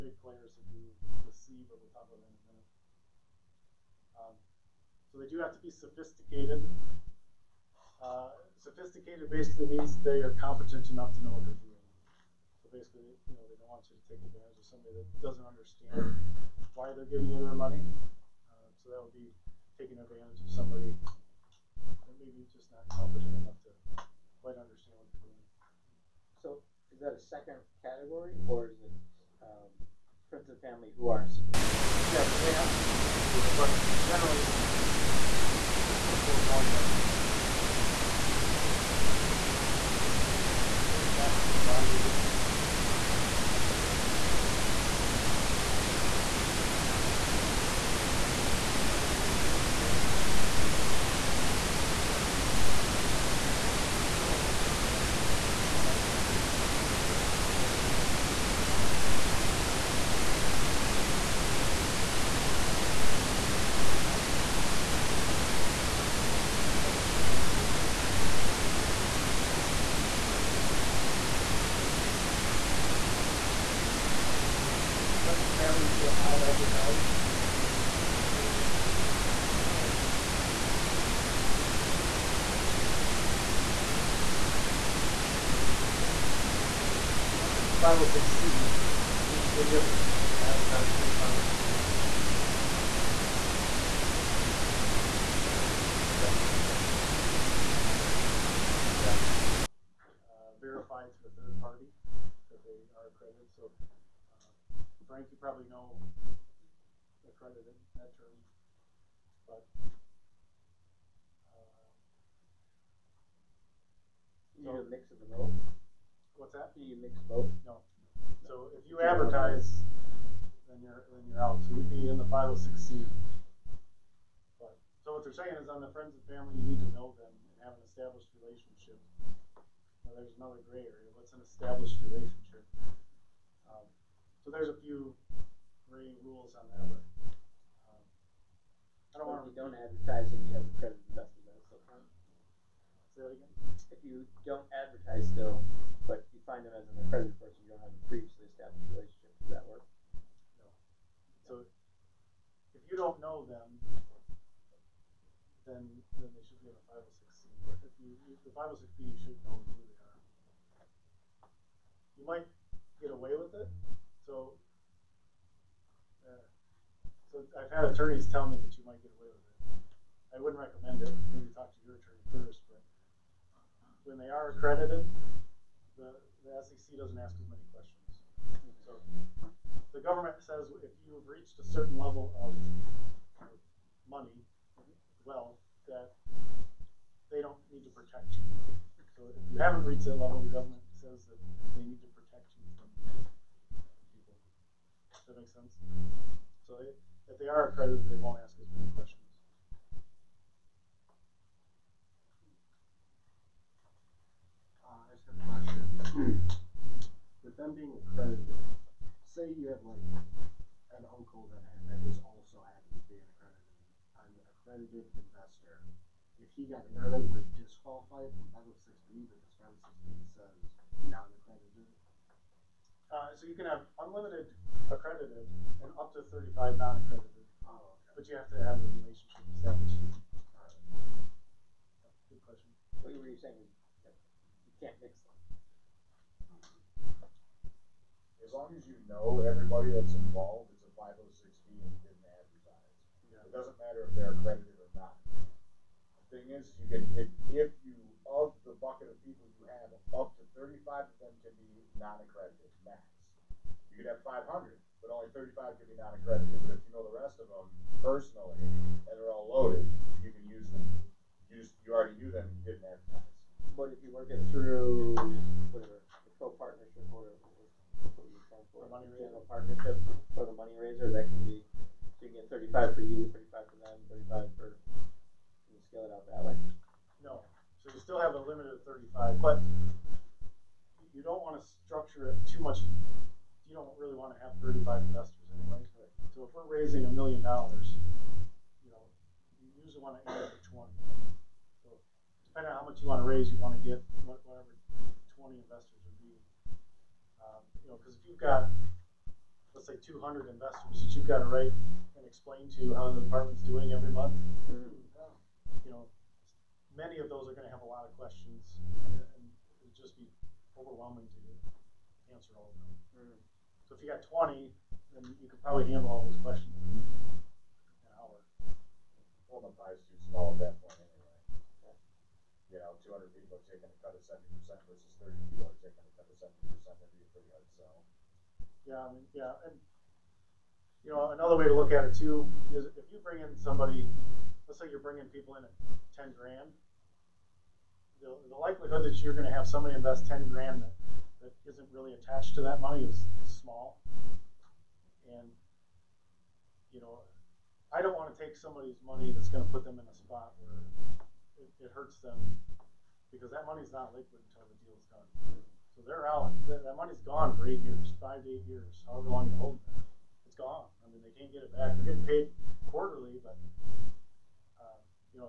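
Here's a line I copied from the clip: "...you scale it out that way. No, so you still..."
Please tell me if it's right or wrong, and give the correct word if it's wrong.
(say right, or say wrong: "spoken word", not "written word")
right.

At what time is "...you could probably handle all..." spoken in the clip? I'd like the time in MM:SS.
05:15.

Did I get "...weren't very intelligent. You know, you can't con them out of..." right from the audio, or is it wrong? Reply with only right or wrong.
right.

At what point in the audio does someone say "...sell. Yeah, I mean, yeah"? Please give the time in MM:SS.
05:27.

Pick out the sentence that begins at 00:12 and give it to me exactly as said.
So basically, you know, they don't want you to take advantage of somebody that doesn't understand why they're giving you their money.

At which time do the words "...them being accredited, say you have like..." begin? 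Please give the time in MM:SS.
03:27.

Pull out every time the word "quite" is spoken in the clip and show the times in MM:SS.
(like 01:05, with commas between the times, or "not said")
00:24.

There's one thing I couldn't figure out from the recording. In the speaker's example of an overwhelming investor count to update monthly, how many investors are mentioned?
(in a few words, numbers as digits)
200.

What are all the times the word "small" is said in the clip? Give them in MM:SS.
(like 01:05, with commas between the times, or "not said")
05:20, 05:43.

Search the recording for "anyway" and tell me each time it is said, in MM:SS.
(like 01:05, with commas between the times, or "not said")
04:45, 05:21.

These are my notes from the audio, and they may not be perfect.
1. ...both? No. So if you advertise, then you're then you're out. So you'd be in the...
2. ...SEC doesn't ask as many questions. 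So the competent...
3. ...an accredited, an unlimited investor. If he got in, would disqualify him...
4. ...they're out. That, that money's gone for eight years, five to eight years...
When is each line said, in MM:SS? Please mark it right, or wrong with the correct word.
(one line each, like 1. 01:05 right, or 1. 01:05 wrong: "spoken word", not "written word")
1. 01:57 right
2. 02:56 wrong: "government", not "competent"
3. 03:33 wrong: "accredited", not "unlimited"
4. 05:56 right.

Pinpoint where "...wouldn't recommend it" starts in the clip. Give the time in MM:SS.
02:50.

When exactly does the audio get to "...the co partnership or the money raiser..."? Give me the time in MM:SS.
04:25.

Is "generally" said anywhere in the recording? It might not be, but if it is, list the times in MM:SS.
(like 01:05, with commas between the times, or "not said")
00:34.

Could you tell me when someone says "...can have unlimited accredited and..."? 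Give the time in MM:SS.
03:43.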